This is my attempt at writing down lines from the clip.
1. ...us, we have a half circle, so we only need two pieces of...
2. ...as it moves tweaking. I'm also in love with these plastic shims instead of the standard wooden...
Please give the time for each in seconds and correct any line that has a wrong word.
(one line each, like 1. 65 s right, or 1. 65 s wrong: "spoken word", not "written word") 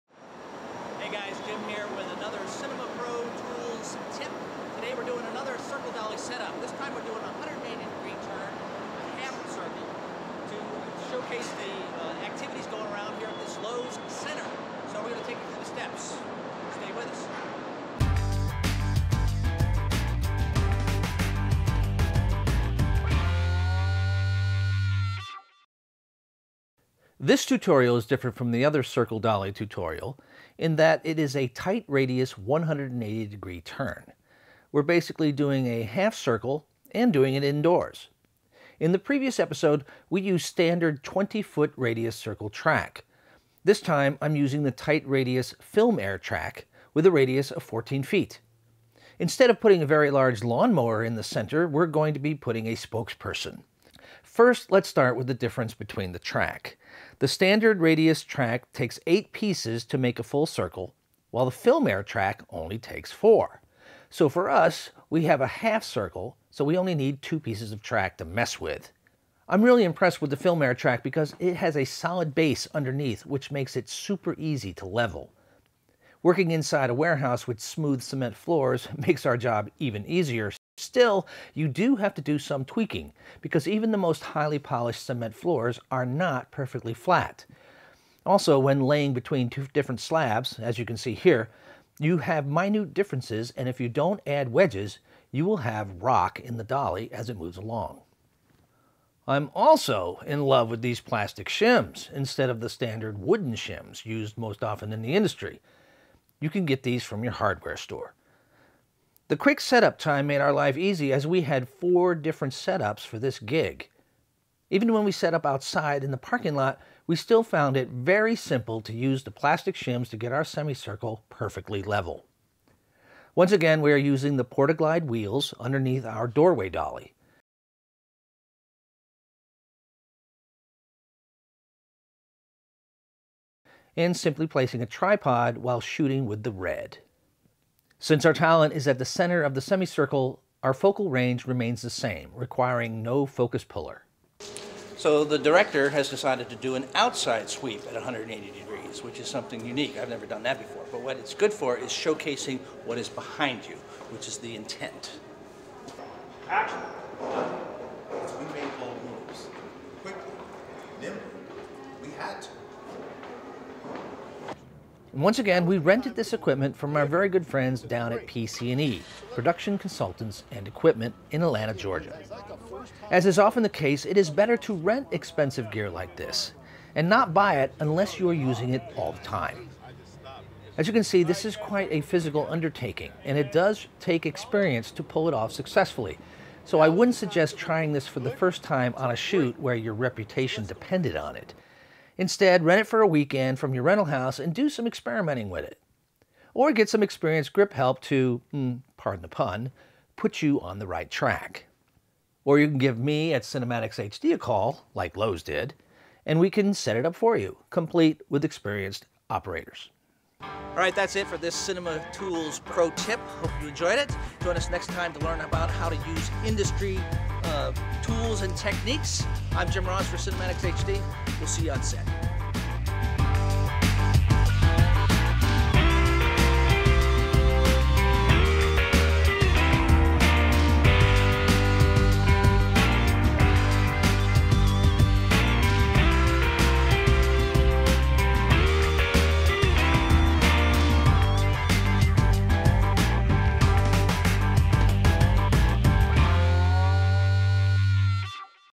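1. 64 s right
2. 97 s wrong: "along", not "tweaking".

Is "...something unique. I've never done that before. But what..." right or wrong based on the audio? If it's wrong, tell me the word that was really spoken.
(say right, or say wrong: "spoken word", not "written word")
right.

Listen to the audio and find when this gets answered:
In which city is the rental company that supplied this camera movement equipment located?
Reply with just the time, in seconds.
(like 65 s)
171 s.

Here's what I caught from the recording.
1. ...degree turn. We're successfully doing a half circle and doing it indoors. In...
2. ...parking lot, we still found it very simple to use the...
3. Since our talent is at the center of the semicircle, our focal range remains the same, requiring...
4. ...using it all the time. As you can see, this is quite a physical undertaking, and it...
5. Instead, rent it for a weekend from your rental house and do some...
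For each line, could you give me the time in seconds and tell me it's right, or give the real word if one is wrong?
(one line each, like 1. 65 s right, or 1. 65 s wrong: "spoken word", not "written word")
1. 33 s wrong: "basically", not "successfully"
2. 116 s right
3. 138 s right
4. 178 s right
5. 192 s right.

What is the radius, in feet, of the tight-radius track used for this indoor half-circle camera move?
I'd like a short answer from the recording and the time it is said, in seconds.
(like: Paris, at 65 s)
14 feet, at 47 s.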